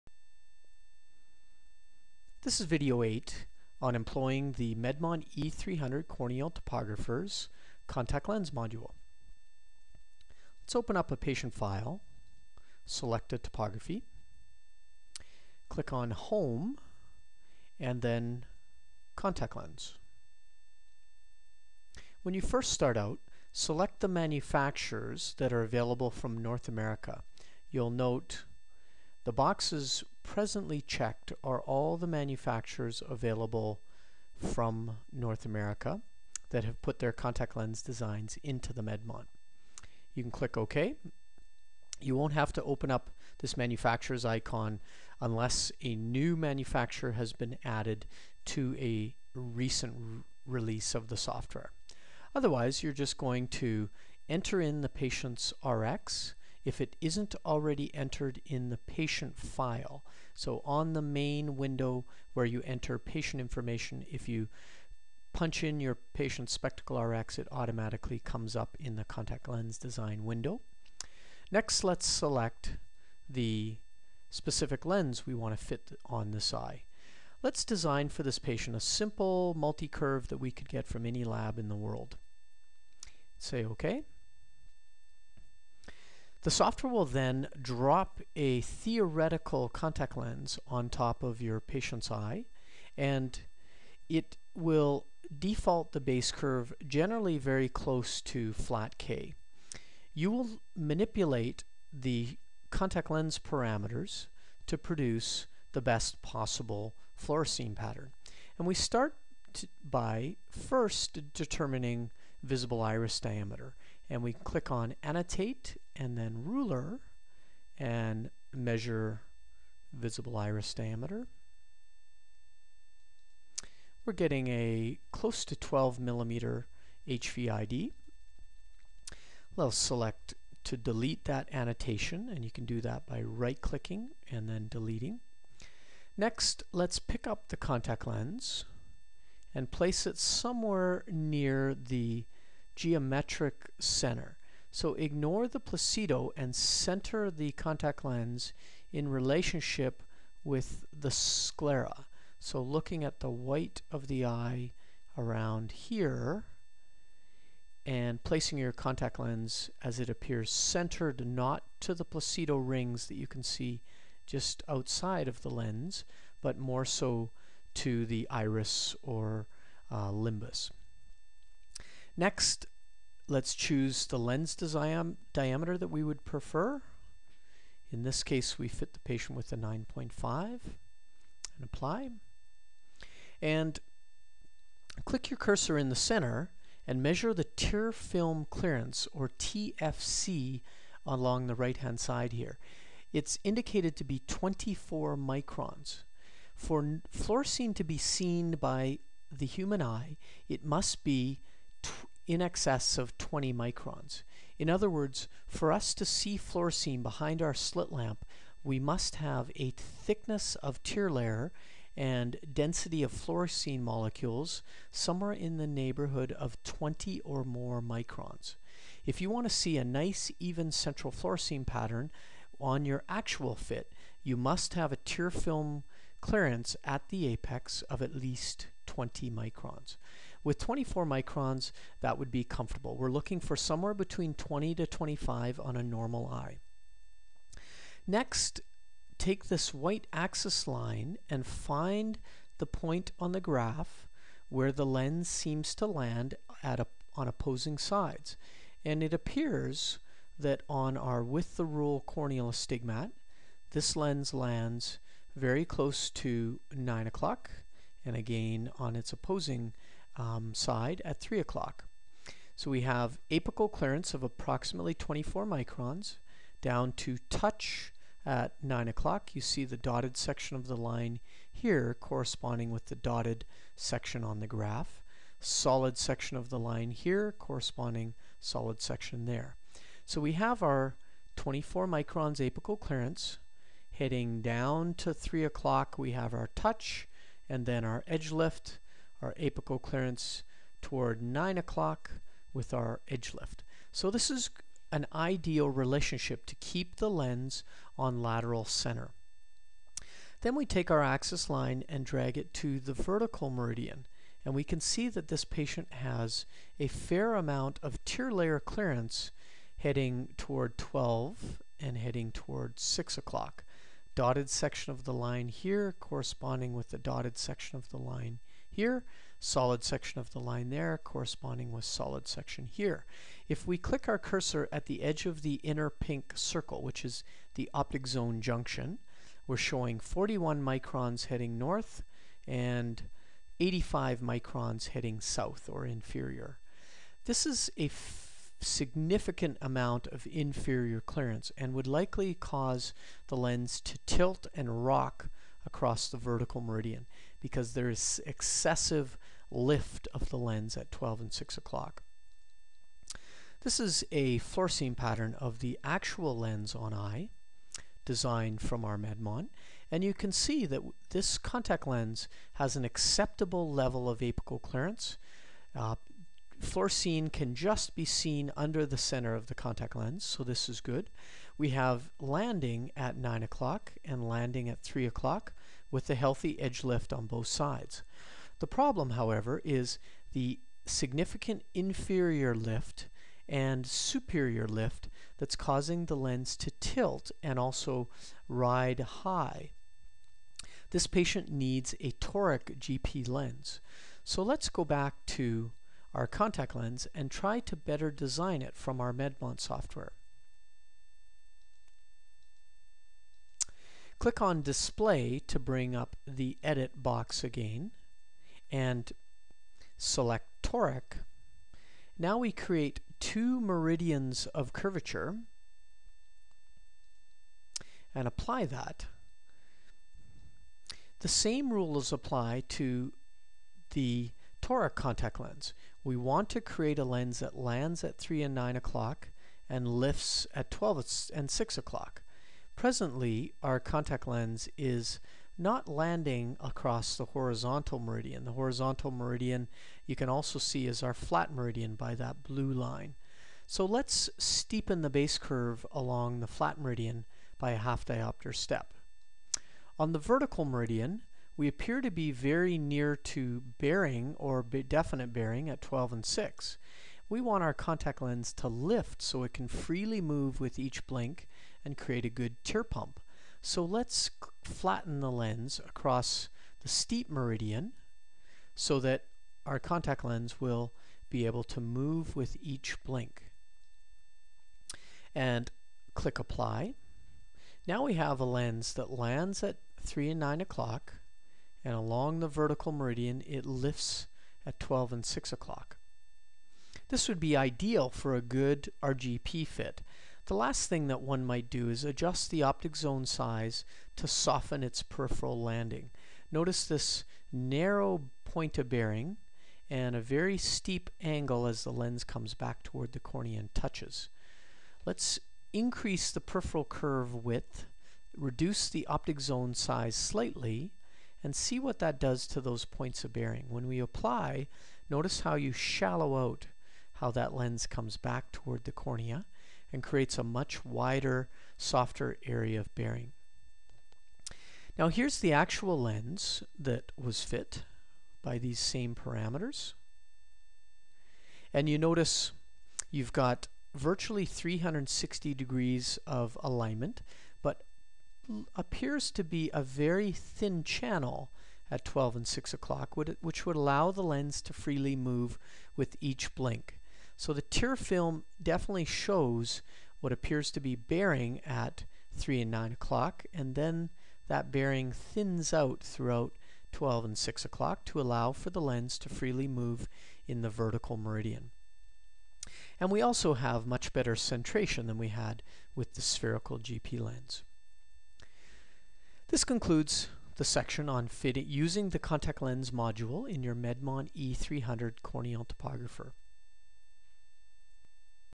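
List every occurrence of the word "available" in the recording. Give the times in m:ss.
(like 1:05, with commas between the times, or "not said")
0:25, 0:33.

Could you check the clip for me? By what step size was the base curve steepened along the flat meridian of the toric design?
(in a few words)
half diopter.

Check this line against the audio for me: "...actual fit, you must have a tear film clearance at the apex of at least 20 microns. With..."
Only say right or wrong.
right.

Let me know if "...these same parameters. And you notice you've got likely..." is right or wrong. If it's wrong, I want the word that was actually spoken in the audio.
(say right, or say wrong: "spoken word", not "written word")
wrong: "virtually", not "likely".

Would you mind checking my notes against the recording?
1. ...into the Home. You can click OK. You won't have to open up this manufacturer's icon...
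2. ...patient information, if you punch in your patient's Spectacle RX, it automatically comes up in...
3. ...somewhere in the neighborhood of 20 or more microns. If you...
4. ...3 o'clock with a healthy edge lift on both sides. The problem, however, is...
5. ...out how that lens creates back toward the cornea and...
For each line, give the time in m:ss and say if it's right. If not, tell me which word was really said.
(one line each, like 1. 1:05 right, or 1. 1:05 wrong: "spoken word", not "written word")
1. 0:38 wrong: "Medmont", not "Home"
2. 1:02 right
3. 3:34 right
4. 6:14 right
5. 8:36 wrong: "comes", not "creates".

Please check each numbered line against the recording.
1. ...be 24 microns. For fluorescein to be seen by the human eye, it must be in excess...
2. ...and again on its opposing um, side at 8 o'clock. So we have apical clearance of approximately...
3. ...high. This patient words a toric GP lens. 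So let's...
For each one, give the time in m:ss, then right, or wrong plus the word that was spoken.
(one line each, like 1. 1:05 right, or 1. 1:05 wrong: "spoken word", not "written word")
1. 3:14 right
2. 4:18 wrong: "3", not "8"
3. 6:29 wrong: "needs", not "words".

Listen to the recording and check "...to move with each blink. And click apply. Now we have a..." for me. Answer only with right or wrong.
right.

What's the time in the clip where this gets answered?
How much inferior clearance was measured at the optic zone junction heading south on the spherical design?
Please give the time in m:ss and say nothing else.
5:33.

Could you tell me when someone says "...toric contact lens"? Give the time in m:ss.
7:04.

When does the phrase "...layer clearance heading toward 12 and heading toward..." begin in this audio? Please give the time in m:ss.
5:08.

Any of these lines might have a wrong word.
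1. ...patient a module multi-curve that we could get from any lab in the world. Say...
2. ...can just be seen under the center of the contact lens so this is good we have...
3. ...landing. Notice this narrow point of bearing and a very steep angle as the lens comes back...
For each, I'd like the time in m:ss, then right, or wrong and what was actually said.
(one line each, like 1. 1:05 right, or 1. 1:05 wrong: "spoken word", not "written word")
1. 1:18 wrong: "simple", not "module"
2. 6:07 right
3. 8:15 right.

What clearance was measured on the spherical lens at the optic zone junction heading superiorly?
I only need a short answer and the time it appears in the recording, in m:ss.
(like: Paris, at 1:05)
41 microns, at 5:29.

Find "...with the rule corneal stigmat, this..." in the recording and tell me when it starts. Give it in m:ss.
4:11.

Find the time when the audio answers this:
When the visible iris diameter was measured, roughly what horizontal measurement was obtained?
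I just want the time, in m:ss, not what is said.
2:05.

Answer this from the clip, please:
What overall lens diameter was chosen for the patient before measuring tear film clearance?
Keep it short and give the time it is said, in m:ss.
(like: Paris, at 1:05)
9.5, at 2:59.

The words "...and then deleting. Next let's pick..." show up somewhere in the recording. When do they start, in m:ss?
2:14.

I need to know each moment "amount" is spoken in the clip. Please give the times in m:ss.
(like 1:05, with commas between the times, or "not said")
5:07, 5:39.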